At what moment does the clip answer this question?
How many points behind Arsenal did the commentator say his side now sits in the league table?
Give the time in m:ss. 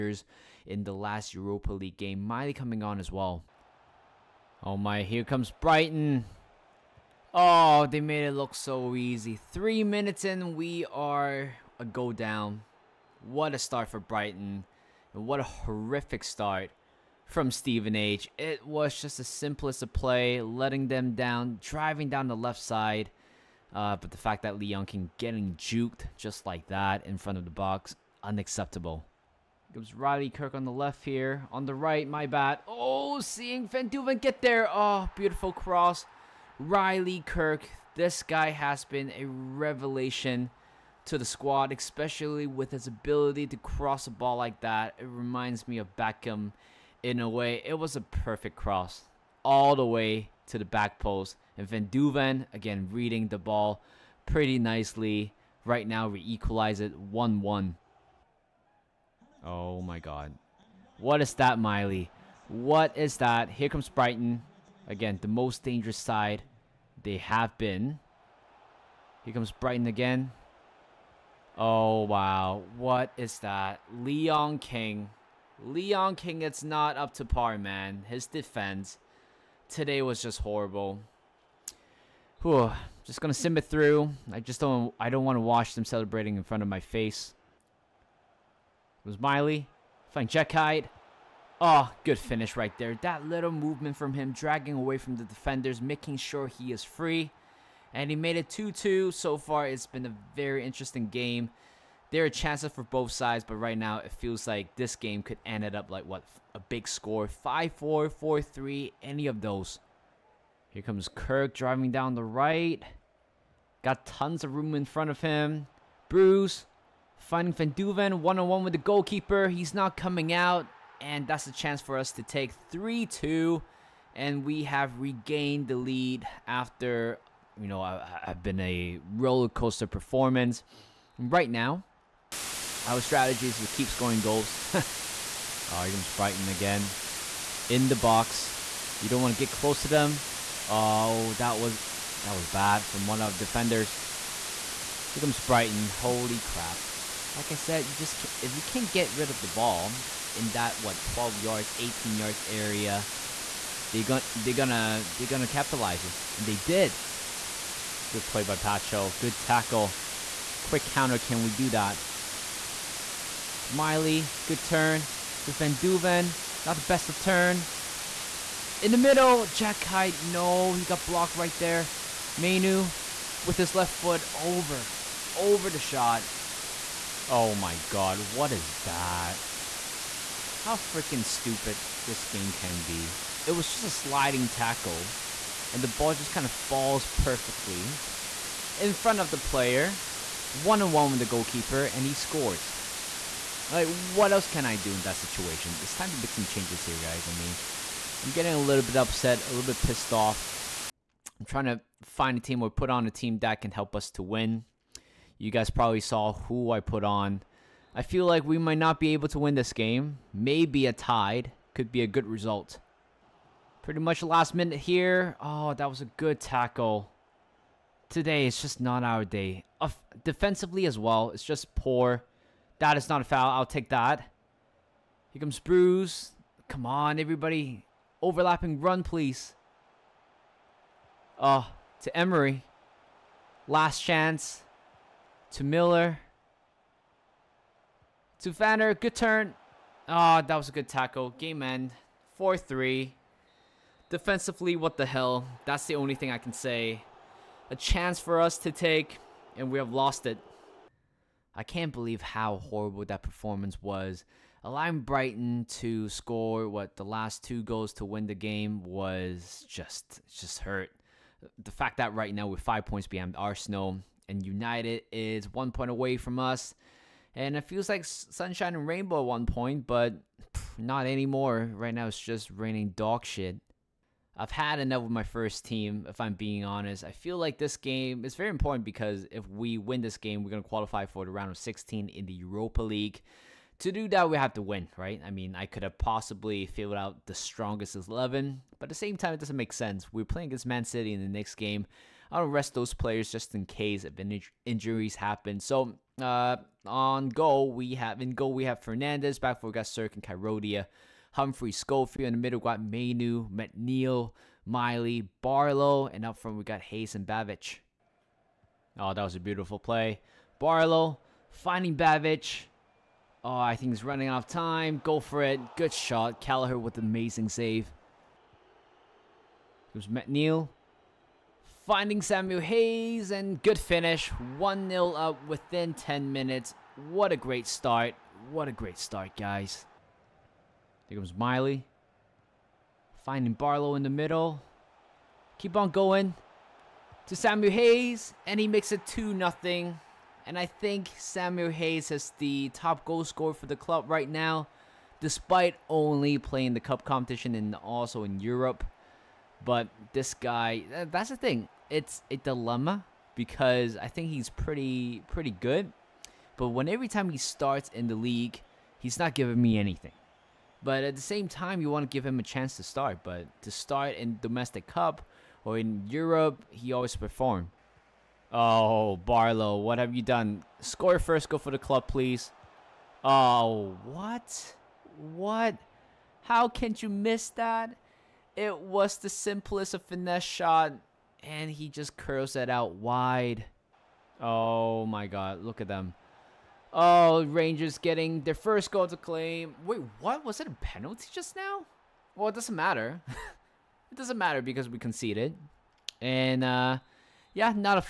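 4:22.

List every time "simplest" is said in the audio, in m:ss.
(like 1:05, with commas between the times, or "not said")
0:19, 6:19.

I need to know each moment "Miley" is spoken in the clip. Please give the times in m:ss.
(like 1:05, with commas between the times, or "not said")
0:02, 1:01, 1:29, 2:43, 5:04, 5:31.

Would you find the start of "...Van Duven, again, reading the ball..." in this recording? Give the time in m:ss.
0:51.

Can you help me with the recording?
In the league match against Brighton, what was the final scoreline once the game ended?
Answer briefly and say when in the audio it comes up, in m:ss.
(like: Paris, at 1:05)
4-3, at 4:02.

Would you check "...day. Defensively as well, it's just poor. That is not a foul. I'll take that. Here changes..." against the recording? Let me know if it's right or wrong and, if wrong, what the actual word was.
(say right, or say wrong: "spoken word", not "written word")
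wrong: "comes", not "changes".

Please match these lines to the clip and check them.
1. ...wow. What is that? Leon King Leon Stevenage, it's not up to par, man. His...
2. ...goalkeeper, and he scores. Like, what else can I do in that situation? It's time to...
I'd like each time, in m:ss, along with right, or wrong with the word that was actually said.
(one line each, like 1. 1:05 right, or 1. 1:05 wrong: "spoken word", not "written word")
1. 1:12 wrong: "King", not "Stevenage"
2. 3:11 right.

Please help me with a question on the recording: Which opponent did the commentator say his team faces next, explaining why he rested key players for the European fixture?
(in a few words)
Man City.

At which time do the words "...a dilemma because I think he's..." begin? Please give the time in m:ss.
5:52.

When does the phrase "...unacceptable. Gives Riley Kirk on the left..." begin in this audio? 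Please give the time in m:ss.
0:28.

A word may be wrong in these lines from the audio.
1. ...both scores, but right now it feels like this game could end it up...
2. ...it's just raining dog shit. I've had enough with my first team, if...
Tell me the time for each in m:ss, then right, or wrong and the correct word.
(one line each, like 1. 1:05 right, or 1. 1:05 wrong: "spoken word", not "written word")
1. 1:42 wrong: "sides", not "scores"
2. 4:32 right.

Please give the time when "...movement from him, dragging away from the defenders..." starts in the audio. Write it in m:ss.
1:33.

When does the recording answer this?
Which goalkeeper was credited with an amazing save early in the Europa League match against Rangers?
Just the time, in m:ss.
5:16.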